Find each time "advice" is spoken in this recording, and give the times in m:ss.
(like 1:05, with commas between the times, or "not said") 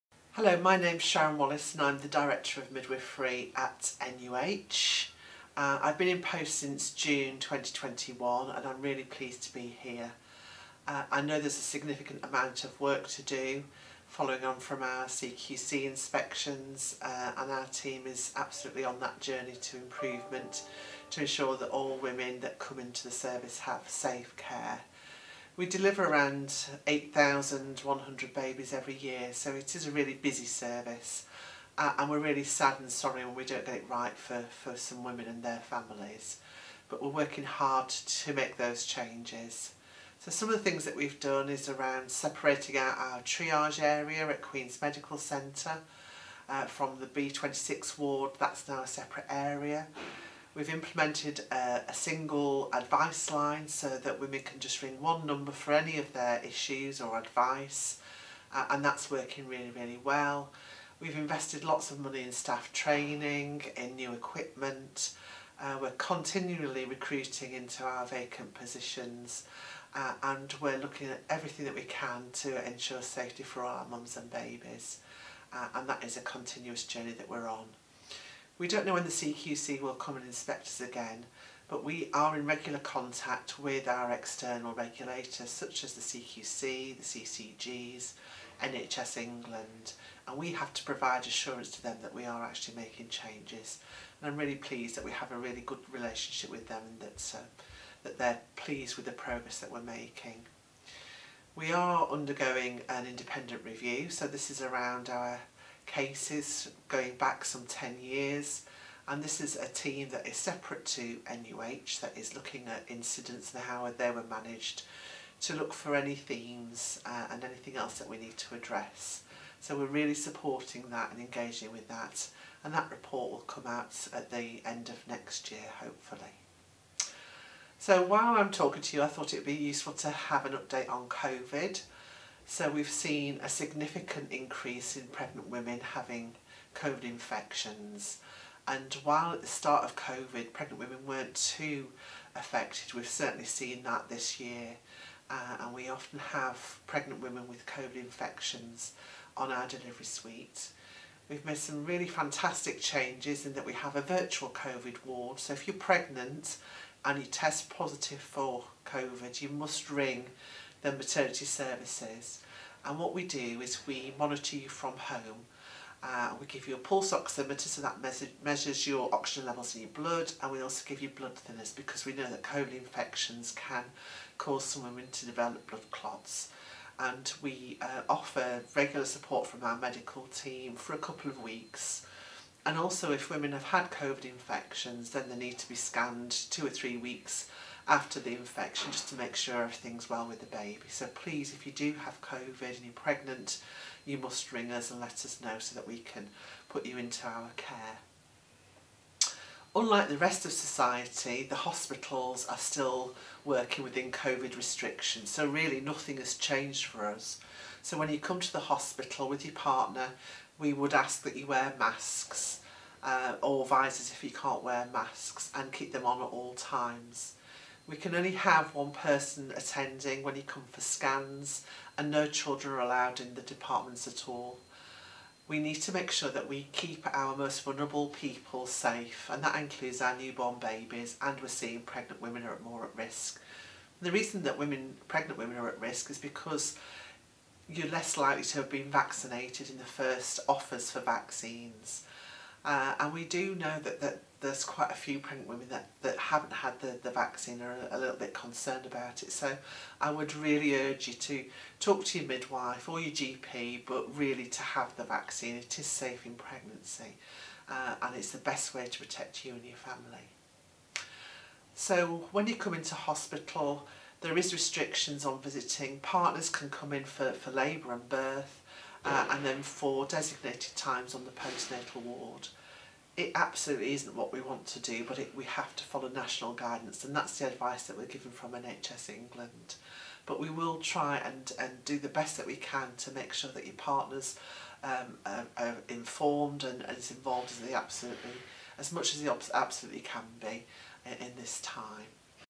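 0:52, 0:57, 4:37.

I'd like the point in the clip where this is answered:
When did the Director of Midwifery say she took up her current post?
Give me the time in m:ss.
0:06.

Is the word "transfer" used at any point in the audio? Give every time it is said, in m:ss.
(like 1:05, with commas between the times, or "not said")
not said.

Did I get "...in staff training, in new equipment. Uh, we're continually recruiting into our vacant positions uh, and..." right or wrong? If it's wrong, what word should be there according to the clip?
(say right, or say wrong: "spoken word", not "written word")
right.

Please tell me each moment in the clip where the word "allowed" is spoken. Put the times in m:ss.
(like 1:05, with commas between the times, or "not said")
3:42.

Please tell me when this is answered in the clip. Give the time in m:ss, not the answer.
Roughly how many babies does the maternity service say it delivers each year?
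0:26.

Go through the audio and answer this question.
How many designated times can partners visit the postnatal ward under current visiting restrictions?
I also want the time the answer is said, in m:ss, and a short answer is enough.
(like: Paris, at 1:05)
4, at 4:29.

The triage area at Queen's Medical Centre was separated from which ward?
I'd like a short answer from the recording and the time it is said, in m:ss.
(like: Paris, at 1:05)
B26, at 0:47.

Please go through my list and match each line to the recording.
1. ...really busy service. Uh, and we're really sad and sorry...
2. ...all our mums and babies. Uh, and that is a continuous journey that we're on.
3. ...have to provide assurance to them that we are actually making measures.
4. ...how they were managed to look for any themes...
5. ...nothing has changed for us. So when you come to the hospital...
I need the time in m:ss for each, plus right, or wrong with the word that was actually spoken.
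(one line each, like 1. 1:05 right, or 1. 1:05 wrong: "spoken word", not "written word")
1. 0:29 right
2. 1:13 right
3. 1:30 wrong: "changes", not "measures"
4. 1:53 right
5. 3:25 right.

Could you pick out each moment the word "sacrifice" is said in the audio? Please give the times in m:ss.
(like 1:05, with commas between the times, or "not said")
not said.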